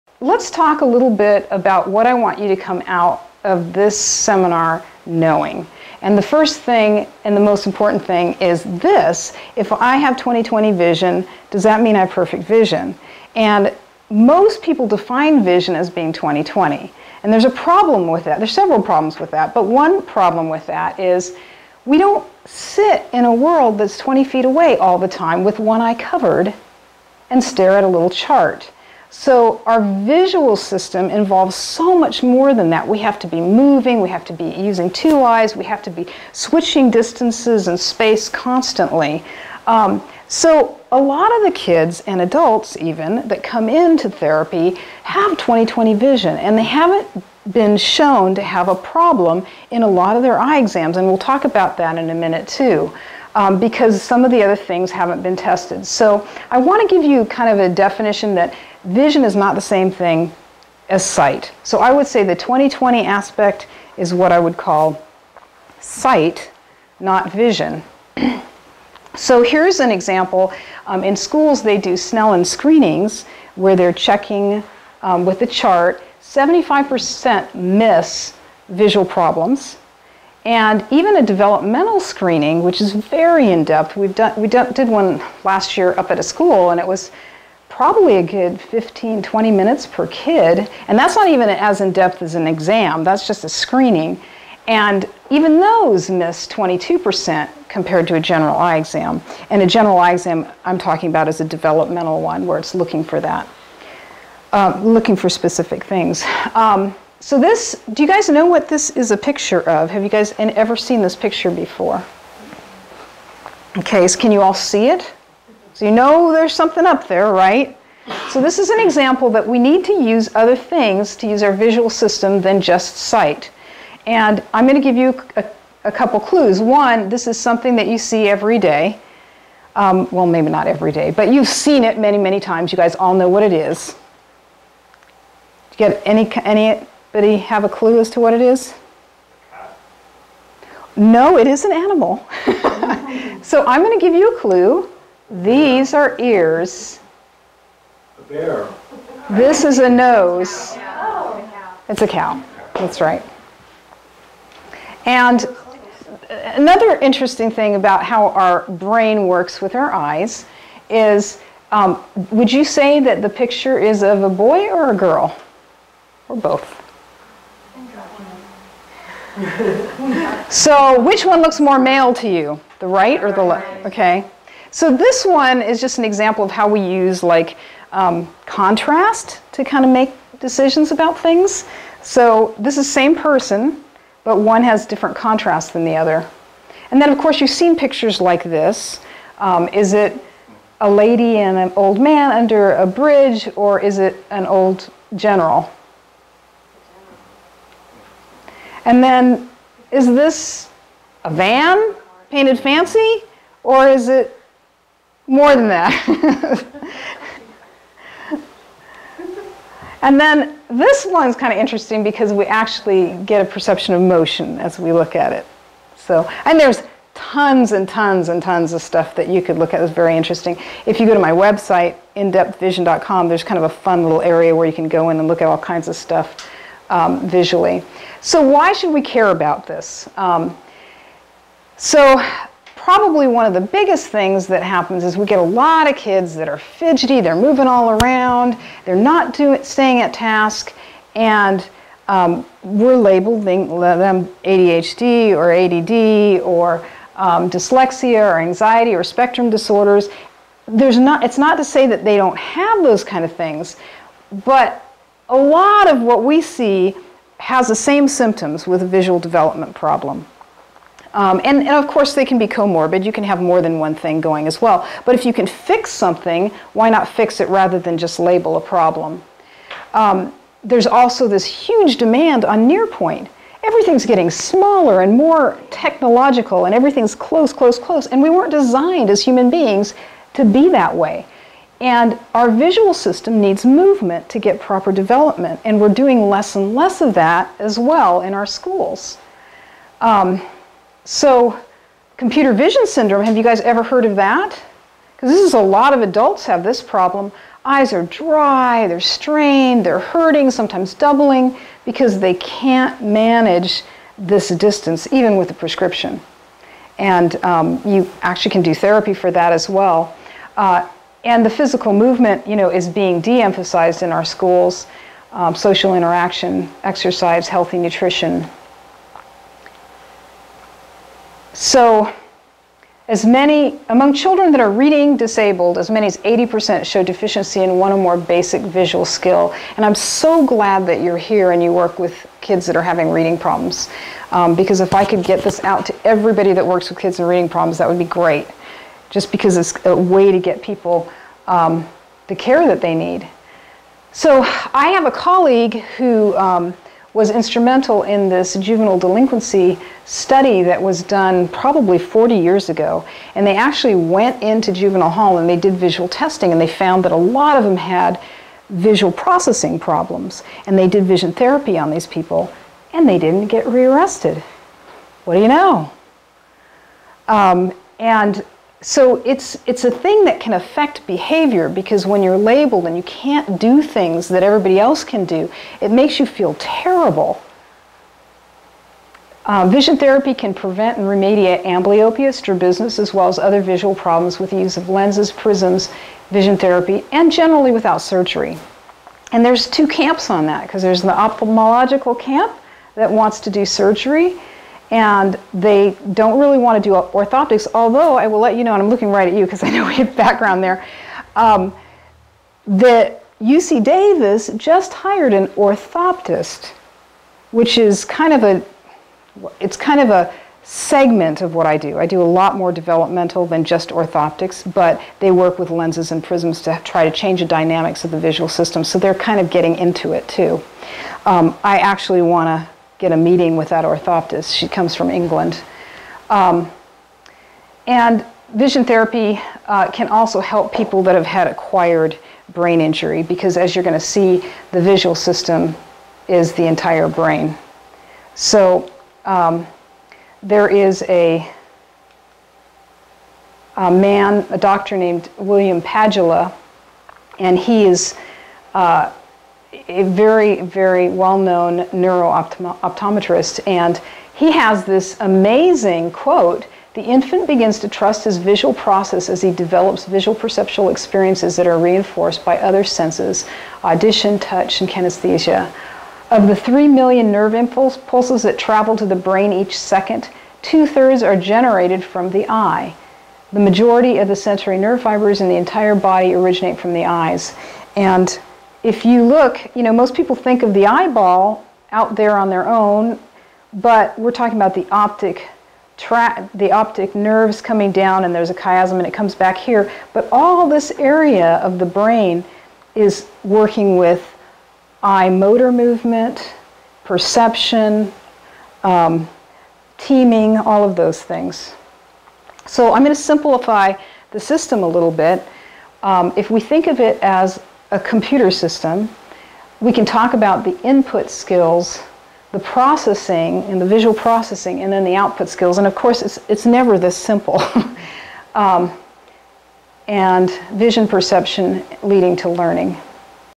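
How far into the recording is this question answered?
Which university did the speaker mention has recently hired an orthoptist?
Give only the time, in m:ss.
6:43.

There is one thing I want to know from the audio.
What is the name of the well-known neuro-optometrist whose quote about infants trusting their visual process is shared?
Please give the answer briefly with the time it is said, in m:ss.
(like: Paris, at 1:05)
William Padula, at 7:25.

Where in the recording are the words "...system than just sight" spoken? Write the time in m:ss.
2:01.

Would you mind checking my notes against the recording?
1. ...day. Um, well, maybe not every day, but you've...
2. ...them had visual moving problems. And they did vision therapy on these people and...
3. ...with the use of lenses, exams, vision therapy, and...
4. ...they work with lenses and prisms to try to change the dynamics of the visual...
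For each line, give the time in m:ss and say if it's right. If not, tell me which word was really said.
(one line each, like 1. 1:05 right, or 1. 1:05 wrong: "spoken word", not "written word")
1. 2:08 right
2. 5:57 wrong: "processing", not "moving"
3. 6:24 wrong: "prisms", not "exams"
4. 6:55 right.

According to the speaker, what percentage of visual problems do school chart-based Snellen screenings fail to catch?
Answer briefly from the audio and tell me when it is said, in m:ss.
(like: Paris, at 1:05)
75%, at 1:16.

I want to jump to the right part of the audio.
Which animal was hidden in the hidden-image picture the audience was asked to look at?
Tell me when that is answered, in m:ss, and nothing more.
2:32.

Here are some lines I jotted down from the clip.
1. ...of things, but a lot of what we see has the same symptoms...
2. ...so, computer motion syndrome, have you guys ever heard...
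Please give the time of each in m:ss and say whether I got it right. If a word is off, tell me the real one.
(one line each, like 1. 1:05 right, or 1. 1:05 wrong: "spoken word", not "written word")
1. 4:13 right
2. 4:51 wrong: "vision", not "motion".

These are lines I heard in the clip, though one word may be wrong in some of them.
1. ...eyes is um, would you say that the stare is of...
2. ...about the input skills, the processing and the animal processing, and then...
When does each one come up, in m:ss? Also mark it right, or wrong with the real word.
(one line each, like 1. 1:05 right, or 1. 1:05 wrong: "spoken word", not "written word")
1. 2:39 wrong: "picture", not "stare"
2. 8:30 wrong: "visual", not "animal".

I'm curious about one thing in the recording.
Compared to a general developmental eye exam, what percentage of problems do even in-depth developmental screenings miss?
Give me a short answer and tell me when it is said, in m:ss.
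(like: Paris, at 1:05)
22%, at 1:36.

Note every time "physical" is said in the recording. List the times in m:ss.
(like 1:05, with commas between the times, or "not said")
5:11.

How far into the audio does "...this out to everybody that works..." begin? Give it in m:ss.
5:35.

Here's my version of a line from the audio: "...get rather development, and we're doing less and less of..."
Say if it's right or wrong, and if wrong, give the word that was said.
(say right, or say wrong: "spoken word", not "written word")
wrong: "proper", not "rather".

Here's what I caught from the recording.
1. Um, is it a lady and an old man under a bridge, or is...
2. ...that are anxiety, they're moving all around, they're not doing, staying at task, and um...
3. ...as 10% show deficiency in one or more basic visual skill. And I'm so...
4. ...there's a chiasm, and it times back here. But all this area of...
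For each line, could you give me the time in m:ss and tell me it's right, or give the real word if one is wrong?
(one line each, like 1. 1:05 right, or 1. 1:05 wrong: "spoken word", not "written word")
1. 3:09 right
2. 3:56 wrong: "fidgety", not "anxiety"
3. 5:26 wrong: "80", not "10"
4. 8:08 wrong: "comes", not "times".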